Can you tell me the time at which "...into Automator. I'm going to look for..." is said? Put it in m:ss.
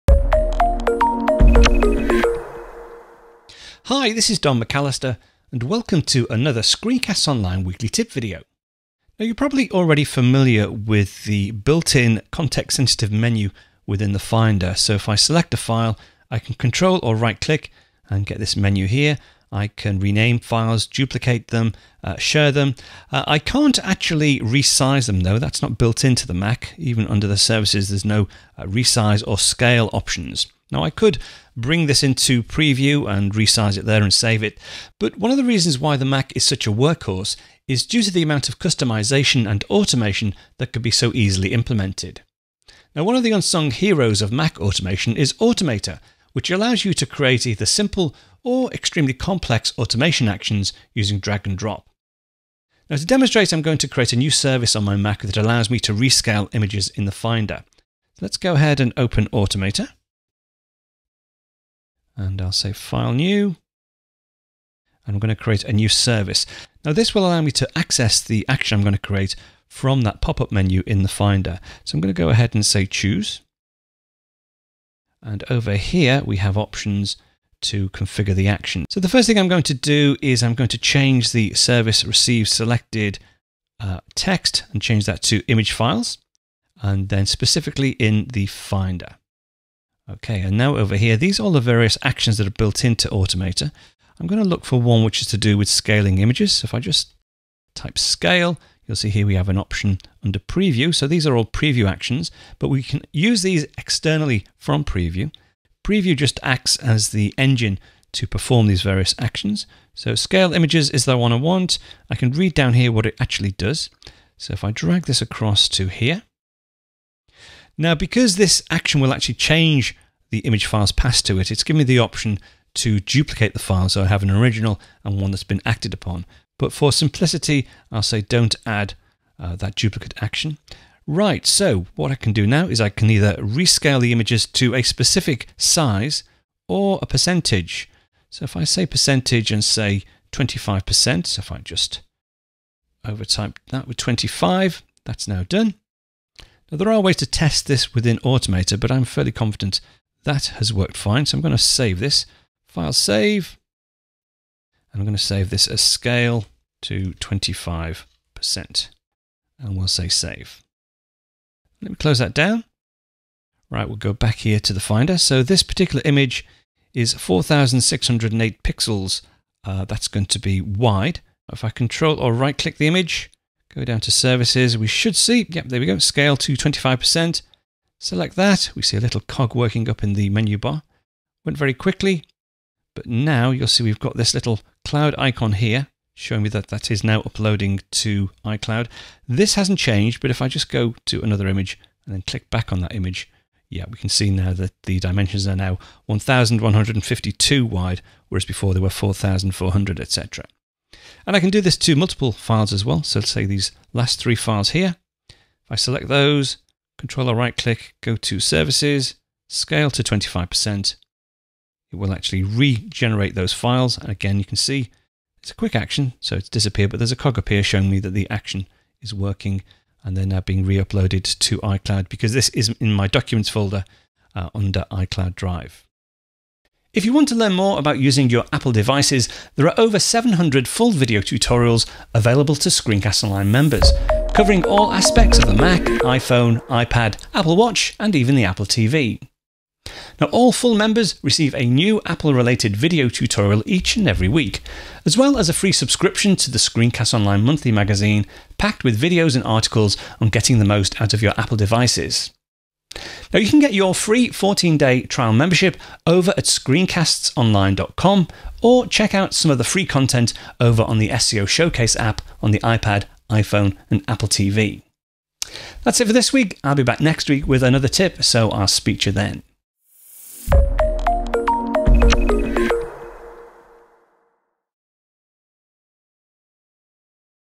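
1:32.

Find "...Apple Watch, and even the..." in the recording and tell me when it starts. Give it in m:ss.
3:57.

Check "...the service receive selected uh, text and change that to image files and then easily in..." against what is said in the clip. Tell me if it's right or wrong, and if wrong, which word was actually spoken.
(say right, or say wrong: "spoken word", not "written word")
wrong: "specifically", not "easily".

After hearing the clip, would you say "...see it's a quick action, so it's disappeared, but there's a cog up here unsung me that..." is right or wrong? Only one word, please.
wrong.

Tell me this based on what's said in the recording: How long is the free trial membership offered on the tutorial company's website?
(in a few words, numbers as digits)
14 days.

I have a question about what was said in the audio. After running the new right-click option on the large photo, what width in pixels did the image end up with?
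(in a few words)
1152.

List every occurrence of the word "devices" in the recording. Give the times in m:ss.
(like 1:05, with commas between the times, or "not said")
3:48, 4:11.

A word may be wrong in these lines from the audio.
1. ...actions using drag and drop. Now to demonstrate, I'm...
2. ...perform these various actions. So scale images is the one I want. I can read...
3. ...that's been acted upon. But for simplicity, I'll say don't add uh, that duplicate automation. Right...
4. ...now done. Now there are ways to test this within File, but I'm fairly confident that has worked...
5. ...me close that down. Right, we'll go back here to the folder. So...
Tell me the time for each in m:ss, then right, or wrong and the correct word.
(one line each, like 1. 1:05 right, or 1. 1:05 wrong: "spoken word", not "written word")
1. 0:50 right
2. 1:48 right
3. 2:05 wrong: "action", not "automation"
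4. 2:25 wrong: "Automator", not "File"
5. 2:41 wrong: "finder", not "folder".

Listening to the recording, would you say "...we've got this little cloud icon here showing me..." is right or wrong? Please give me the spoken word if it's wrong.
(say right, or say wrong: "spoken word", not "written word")
right.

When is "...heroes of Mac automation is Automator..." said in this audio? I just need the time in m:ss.
0:43.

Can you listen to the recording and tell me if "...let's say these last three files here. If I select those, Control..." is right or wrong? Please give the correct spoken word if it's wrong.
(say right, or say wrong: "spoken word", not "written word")
right.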